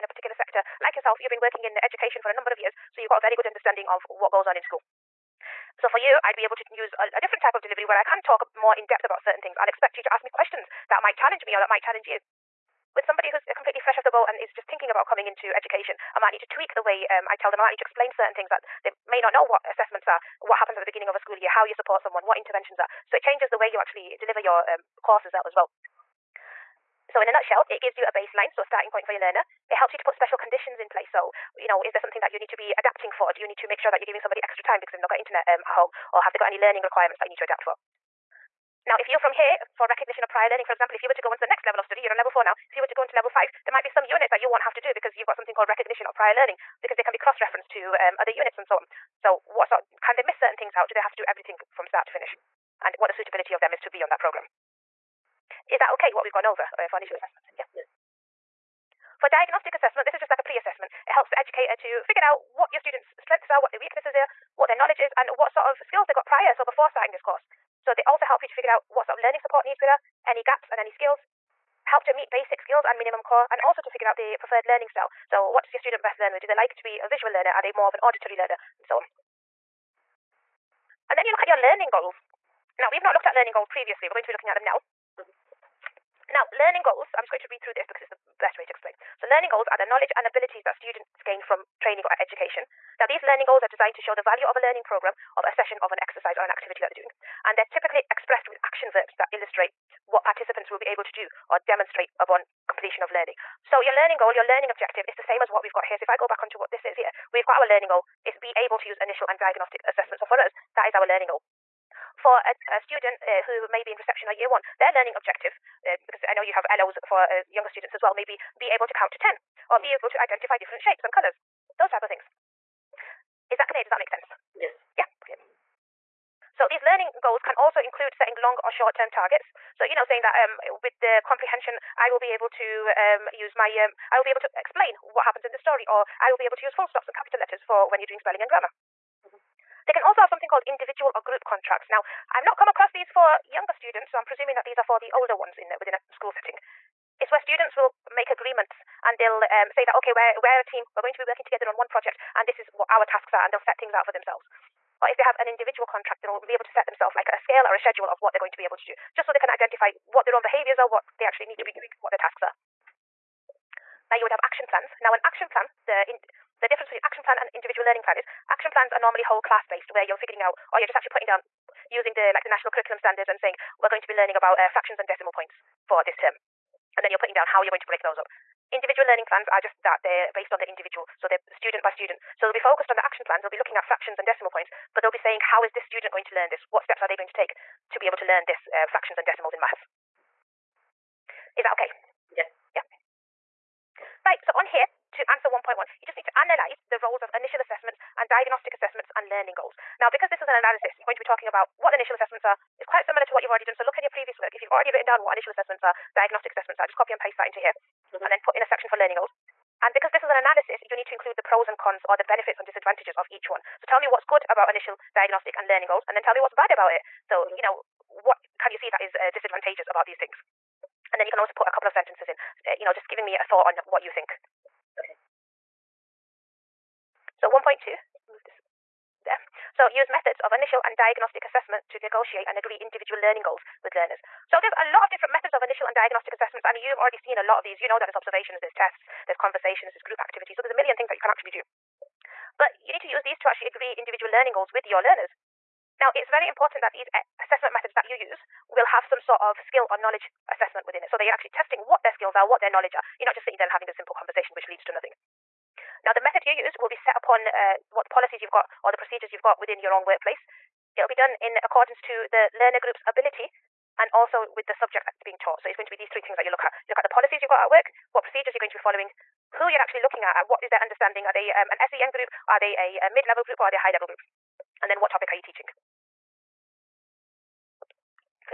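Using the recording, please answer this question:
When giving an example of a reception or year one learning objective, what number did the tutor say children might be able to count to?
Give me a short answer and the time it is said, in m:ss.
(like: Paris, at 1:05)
10, at 1:59.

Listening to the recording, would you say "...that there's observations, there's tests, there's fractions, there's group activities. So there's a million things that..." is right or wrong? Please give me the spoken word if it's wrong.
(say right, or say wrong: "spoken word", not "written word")
wrong: "conversations", not "fractions".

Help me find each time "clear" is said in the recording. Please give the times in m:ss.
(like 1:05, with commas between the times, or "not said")
2:03.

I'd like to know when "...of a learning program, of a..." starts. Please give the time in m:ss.
1:34.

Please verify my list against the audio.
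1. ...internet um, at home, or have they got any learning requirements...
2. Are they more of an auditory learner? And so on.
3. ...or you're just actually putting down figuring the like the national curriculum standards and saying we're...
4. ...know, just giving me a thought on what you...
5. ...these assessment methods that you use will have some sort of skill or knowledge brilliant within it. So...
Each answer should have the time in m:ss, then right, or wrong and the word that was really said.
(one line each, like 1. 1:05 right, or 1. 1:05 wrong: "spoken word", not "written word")
1. 0:35 right
2. 1:17 right
3. 2:50 wrong: "using", not "figuring"
4. 3:42 right
5. 4:06 wrong: "assessment", not "brilliant".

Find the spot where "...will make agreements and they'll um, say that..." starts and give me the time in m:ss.
2:27.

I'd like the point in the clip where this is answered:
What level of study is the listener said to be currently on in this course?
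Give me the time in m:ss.
0:42.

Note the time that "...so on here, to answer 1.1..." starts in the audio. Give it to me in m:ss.
3:14.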